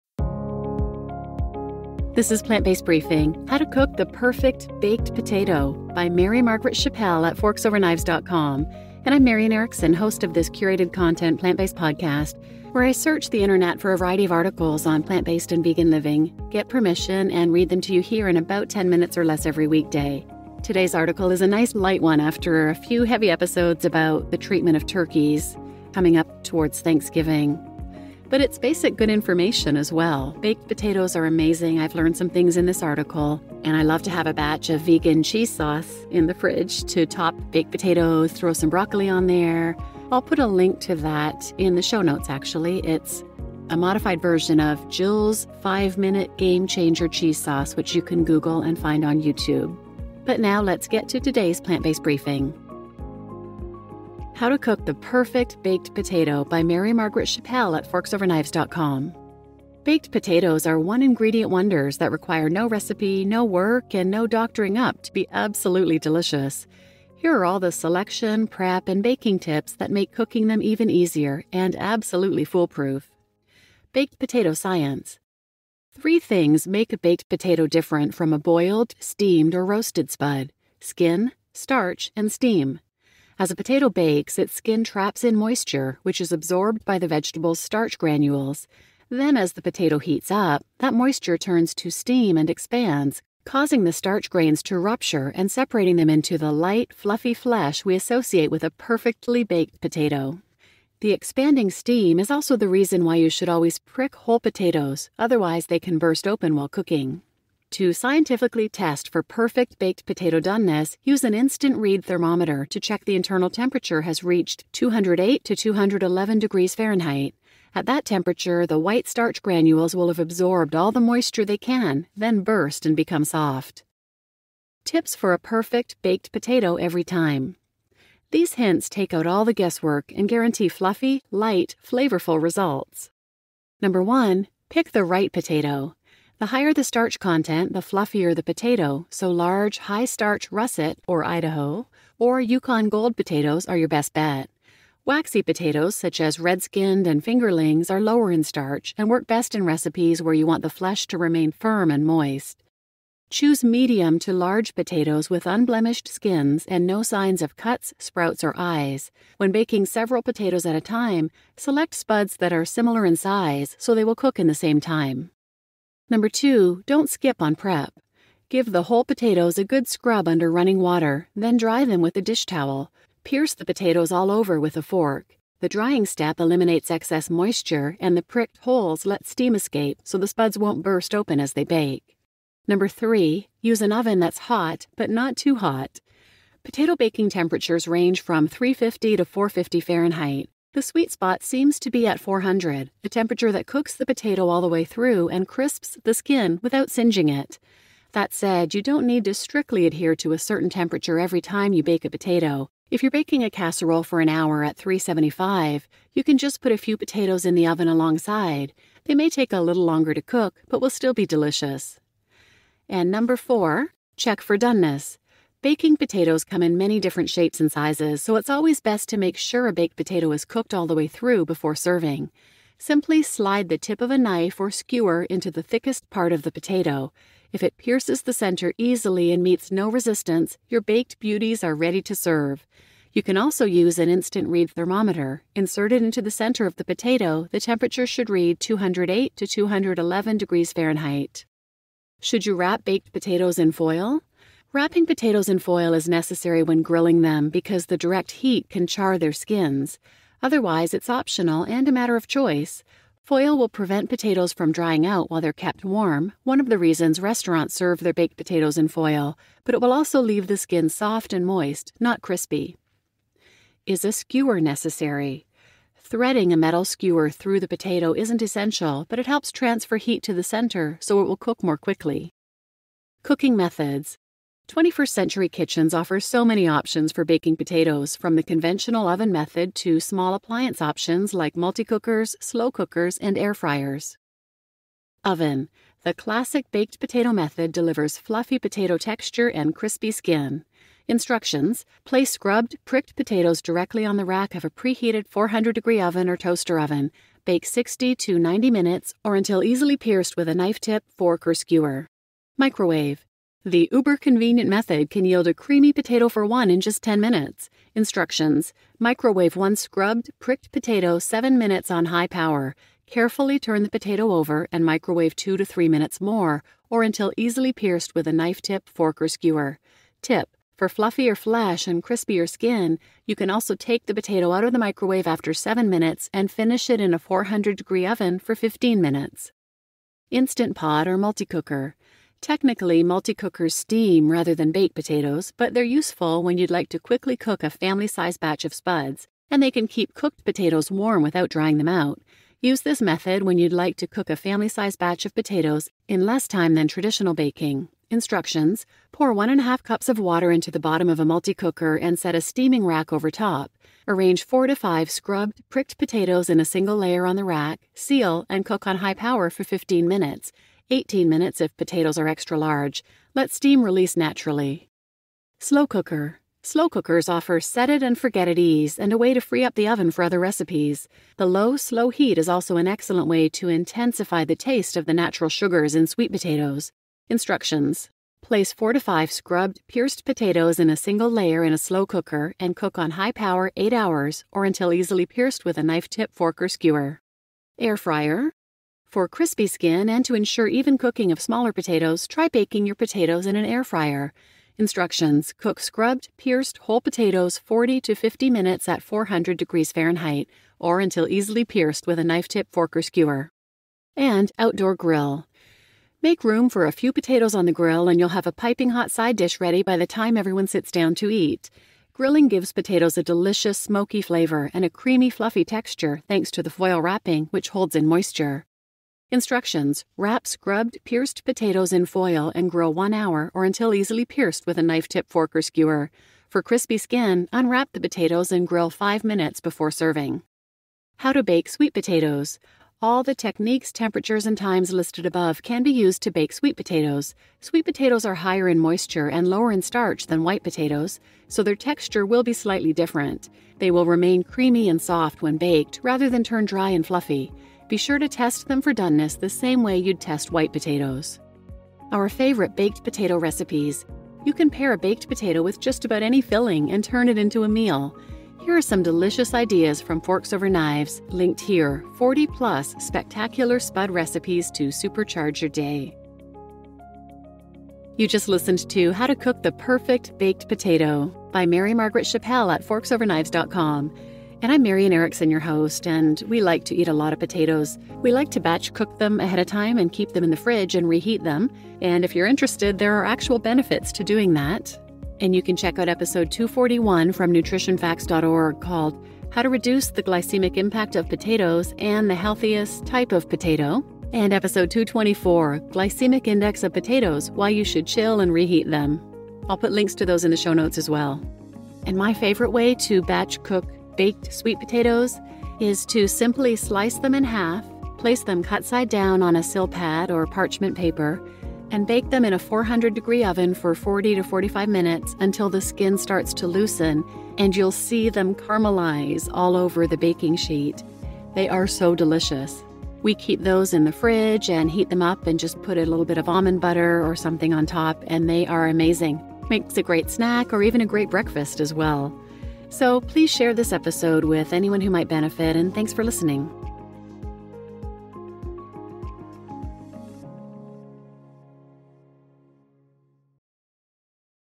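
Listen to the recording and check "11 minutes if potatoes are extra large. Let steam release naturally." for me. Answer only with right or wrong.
wrong.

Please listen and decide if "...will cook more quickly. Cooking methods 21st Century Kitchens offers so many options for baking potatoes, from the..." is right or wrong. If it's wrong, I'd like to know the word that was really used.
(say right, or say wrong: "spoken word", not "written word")
right.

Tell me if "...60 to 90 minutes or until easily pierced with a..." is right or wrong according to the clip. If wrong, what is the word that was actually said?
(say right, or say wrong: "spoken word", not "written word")
right.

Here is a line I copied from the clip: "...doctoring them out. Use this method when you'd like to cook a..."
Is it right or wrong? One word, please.
wrong.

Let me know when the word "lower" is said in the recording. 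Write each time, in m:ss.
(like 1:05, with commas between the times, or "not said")
2:28, 7:19.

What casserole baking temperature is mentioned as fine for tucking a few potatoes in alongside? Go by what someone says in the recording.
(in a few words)
375.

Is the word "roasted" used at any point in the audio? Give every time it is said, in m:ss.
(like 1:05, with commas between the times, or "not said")
1:19.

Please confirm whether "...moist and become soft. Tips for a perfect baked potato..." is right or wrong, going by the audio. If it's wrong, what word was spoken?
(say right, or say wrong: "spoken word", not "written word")
wrong: "burst", not "moist".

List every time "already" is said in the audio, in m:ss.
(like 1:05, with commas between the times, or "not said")
not said.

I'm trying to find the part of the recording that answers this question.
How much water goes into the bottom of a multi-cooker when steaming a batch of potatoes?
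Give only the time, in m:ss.
5:49.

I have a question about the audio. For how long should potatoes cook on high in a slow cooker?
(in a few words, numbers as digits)
8 hours.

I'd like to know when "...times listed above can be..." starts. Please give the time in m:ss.
7:14.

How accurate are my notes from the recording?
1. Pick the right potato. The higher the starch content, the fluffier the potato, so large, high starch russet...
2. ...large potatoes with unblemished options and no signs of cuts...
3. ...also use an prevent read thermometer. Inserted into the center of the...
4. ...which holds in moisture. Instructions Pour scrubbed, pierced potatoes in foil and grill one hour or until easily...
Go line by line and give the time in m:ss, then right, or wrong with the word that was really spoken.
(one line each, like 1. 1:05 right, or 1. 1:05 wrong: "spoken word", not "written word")
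1. 2:14 right
2. 2:34 wrong: "skins", not "options"
3. 3:53 wrong: "instant", not "prevent"
4. 6:57 wrong: "Wrap", not "Pour".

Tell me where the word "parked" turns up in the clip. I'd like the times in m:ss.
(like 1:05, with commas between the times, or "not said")
not said.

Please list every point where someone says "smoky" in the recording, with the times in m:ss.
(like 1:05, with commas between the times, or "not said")
6:53.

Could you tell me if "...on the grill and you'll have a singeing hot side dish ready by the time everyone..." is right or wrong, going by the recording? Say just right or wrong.
wrong.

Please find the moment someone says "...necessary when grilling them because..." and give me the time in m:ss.
4:06.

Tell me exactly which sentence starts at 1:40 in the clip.
The expanding steam is also the reason why you should always prick whole potatoes, otherwise, they can burst open while cooking.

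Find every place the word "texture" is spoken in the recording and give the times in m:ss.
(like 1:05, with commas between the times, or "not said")
4:48, 6:55, 7:21.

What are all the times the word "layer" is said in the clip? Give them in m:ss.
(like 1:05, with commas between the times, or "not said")
5:56, 6:21.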